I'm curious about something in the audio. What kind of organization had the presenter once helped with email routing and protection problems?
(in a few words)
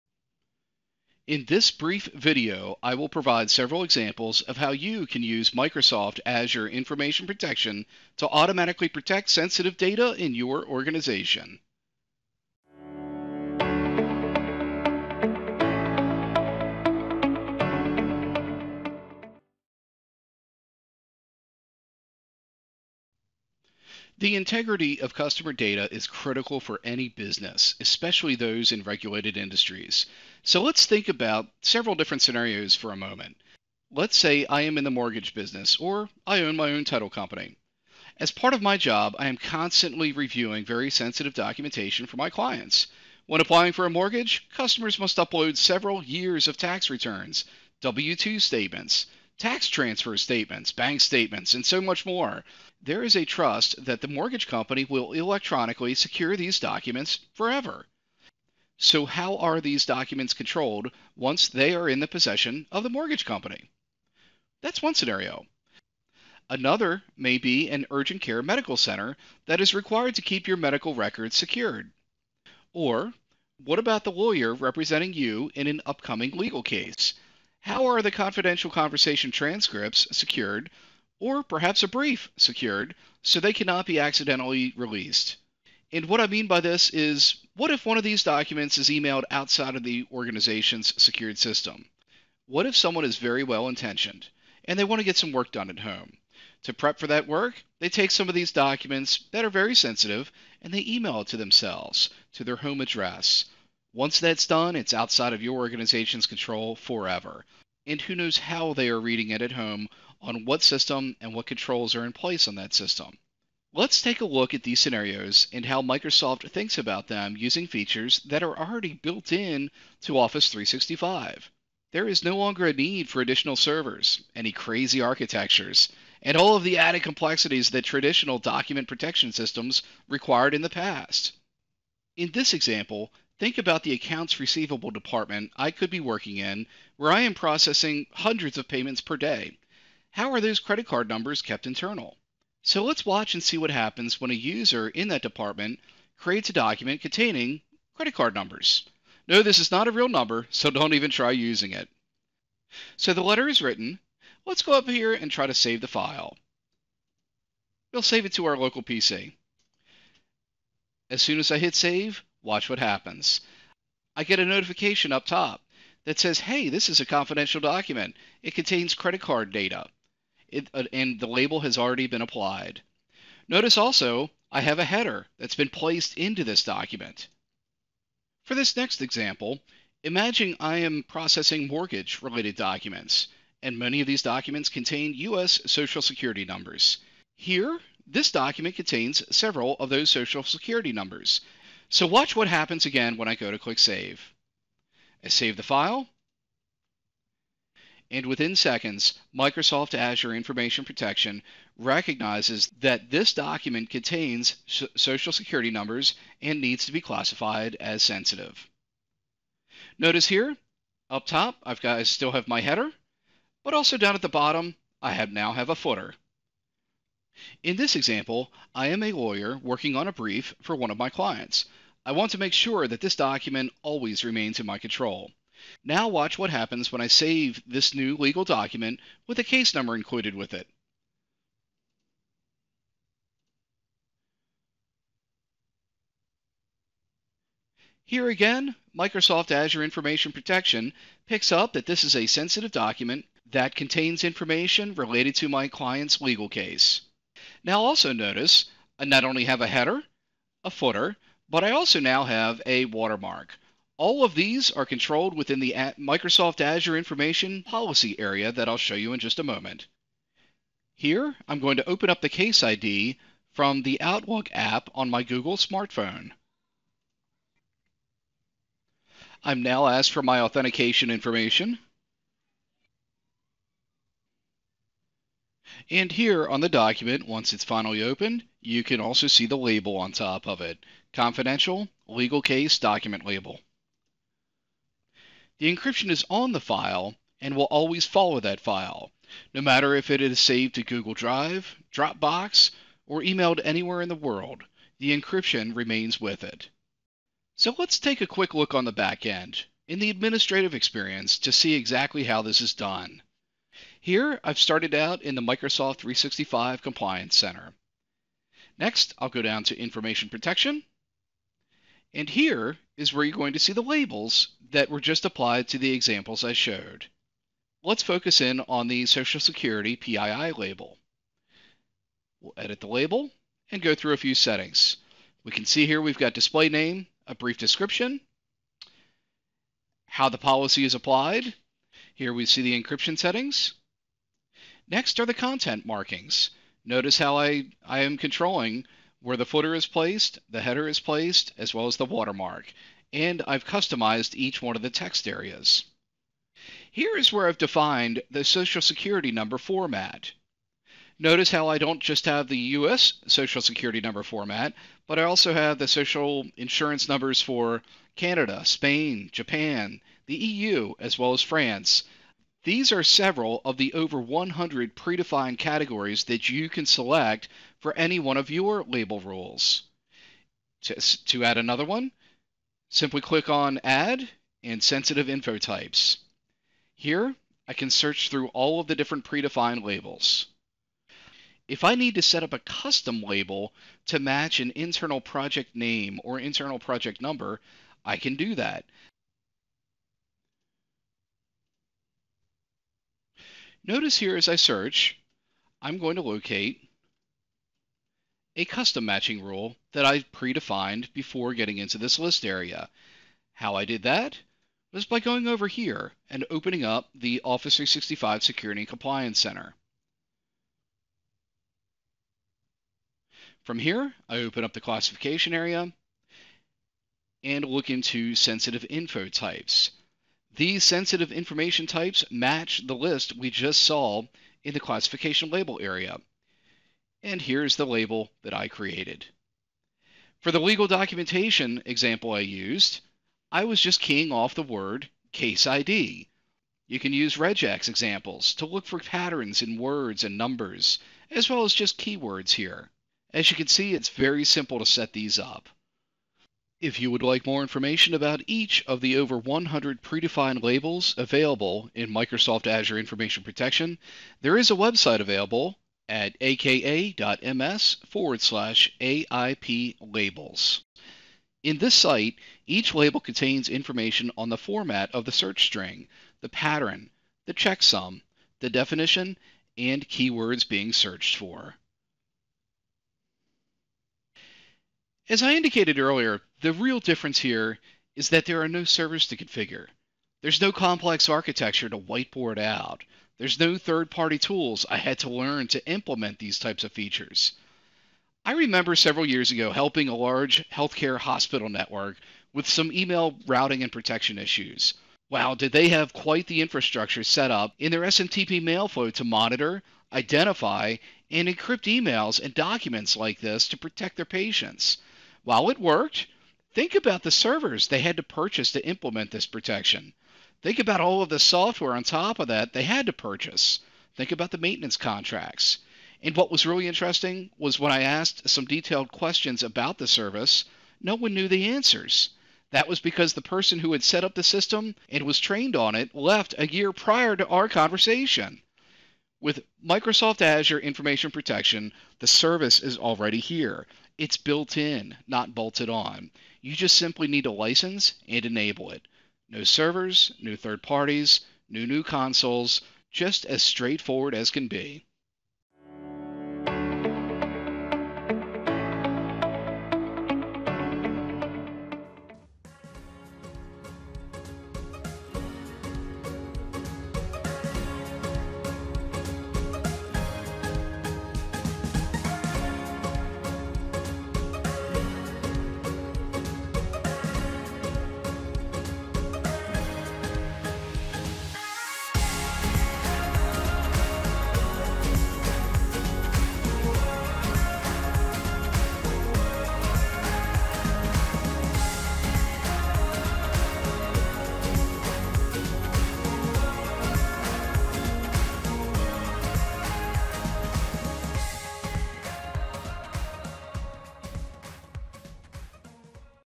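Healthcare hospital network.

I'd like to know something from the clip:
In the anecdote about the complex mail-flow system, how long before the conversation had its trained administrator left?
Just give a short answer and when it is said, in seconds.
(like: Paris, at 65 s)
A year, at 526 s.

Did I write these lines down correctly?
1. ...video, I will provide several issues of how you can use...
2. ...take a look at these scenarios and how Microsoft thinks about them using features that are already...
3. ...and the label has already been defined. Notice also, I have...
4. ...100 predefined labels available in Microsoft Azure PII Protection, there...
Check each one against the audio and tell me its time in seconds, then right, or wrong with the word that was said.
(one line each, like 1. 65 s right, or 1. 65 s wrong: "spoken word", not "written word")
1. 2 s wrong: "examples", not "issues"
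2. 114 s right
3. 170 s wrong: "applied", not "defined"
4. 449 s wrong: "Information", not "PII".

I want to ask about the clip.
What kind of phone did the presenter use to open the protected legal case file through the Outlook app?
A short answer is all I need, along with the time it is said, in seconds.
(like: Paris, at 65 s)
Google smartphone, at 265 s.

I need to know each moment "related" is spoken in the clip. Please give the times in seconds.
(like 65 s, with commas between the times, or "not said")
181 s, 244 s.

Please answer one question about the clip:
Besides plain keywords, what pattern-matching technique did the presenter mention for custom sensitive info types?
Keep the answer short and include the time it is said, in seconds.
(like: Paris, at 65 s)
Regex, at 437 s.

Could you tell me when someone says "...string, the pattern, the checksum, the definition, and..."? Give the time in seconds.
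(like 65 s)
465 s.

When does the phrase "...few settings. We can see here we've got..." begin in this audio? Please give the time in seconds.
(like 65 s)
324 s.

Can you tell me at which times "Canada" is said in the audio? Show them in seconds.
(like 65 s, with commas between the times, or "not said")
358 s.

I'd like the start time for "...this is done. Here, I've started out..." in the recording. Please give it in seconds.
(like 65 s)
302 s.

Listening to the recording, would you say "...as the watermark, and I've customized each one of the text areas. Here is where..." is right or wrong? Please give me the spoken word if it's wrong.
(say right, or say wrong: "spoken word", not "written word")
right.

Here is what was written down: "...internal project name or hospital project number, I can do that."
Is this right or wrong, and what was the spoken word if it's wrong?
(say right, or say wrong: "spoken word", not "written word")
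wrong: "internal", not "hospital".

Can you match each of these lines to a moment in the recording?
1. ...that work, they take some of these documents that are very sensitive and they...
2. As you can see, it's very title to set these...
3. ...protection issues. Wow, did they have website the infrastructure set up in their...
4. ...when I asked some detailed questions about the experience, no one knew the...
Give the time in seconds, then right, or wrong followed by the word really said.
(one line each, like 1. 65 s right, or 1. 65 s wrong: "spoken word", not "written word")
1. 97 s right
2. 443 s wrong: "simple", not "title"
3. 493 s wrong: "quite", not "website"
4. 517 s wrong: "service", not "experience".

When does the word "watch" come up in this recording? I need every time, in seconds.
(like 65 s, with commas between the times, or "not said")
143 s, 162 s, 192 s, 226 s.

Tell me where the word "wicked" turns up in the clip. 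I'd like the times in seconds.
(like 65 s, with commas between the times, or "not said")
not said.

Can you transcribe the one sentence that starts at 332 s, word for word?
Here we see the encryption settings.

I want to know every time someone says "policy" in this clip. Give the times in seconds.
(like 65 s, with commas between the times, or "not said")
257 s, 330 s.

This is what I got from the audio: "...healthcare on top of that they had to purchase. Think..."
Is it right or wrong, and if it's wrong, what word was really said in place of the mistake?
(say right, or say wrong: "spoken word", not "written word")
wrong: "software", not "healthcare".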